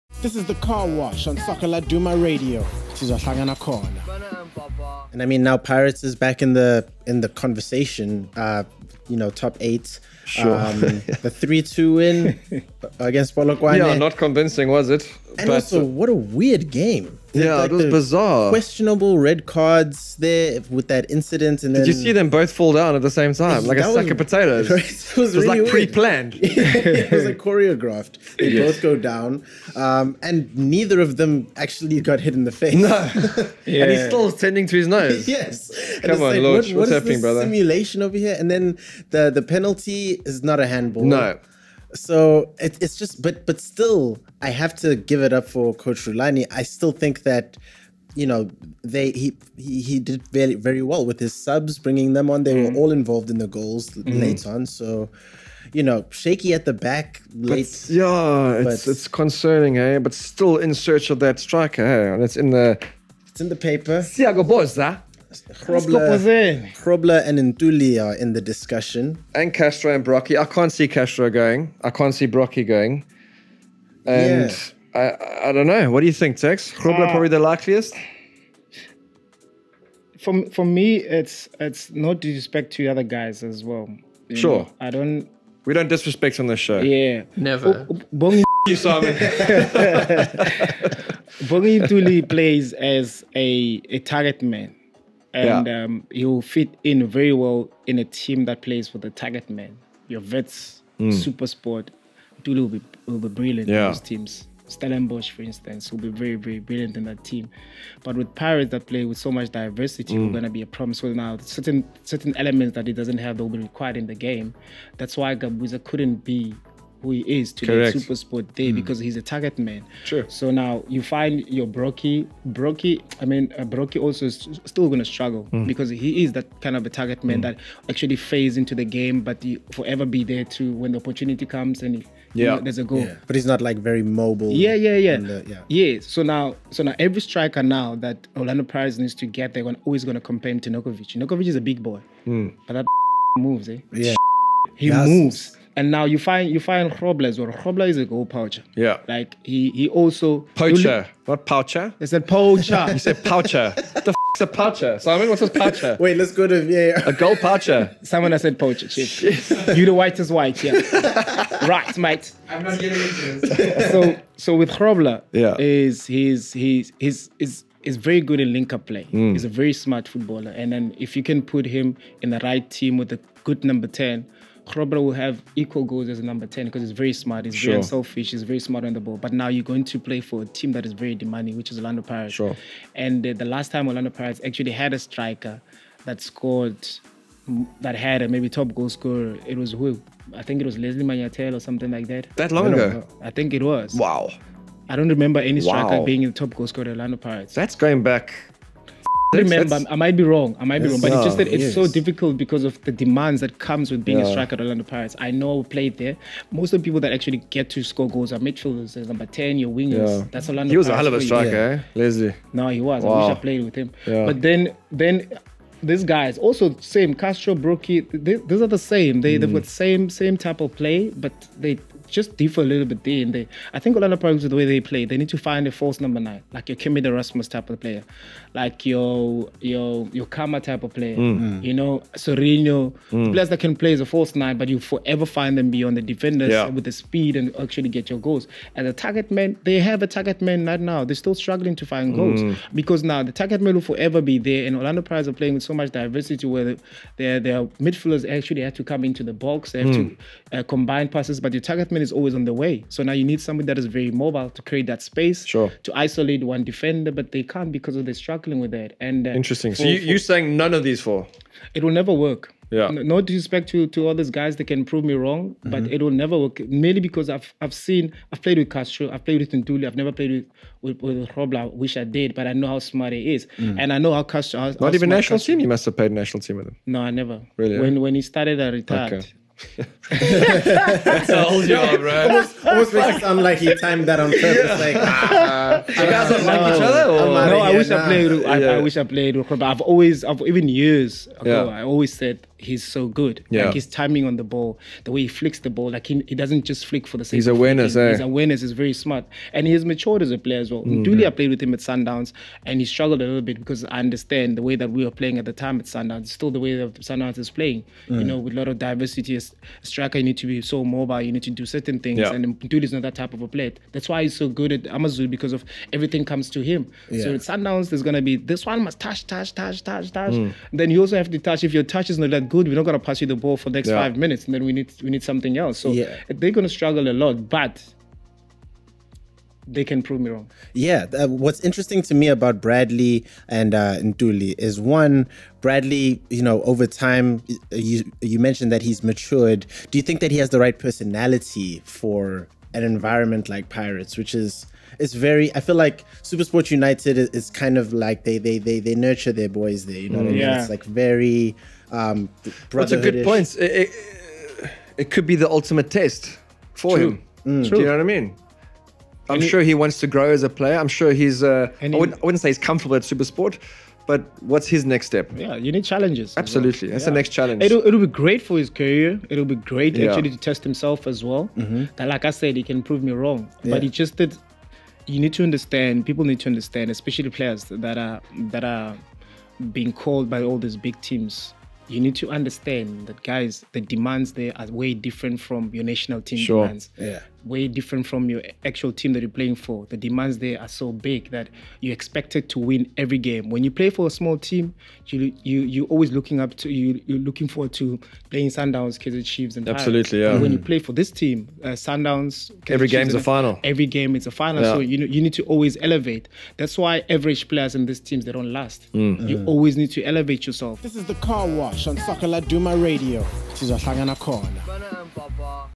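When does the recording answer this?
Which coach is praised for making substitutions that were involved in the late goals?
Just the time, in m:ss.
0:45.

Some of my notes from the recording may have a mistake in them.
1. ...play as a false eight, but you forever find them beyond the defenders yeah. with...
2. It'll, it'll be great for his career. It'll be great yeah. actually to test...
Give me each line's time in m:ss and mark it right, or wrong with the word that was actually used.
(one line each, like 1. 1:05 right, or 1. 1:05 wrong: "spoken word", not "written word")
1. 3:53 wrong: "nine", not "eight"
2. 6:07 right.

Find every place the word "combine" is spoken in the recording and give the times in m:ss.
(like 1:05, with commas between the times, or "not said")
4:10.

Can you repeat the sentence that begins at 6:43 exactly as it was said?
Every game is a final, yeah.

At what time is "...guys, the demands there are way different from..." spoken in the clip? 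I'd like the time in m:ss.
6:23.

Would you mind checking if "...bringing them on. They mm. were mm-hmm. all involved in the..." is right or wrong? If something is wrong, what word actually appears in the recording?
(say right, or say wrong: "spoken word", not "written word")
right.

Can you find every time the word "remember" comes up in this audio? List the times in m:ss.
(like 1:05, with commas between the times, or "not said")
3:15, 3:19.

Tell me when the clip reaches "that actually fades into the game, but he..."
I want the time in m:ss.
2:07.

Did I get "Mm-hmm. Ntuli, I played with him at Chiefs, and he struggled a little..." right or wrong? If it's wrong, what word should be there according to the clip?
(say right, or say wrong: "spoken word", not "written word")
wrong: "Sundowns", not "Chiefs".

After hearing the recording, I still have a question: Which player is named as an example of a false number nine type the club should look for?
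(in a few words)
Kermit Erasmus.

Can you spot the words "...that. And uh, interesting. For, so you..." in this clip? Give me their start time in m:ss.
4:18.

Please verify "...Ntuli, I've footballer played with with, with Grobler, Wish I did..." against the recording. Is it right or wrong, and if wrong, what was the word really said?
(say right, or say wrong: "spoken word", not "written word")
wrong: "never", not "footballer".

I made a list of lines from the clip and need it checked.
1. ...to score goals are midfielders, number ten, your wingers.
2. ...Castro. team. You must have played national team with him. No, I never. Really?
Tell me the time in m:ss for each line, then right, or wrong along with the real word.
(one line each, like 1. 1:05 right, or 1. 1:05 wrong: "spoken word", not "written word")
1. 3:27 right
2. 4:35 right.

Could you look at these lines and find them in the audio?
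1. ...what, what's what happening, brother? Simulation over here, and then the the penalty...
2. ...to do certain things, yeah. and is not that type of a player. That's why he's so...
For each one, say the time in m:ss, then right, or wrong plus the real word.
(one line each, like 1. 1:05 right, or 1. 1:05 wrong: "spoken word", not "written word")
1. 0:36 right
2. 5:11 right.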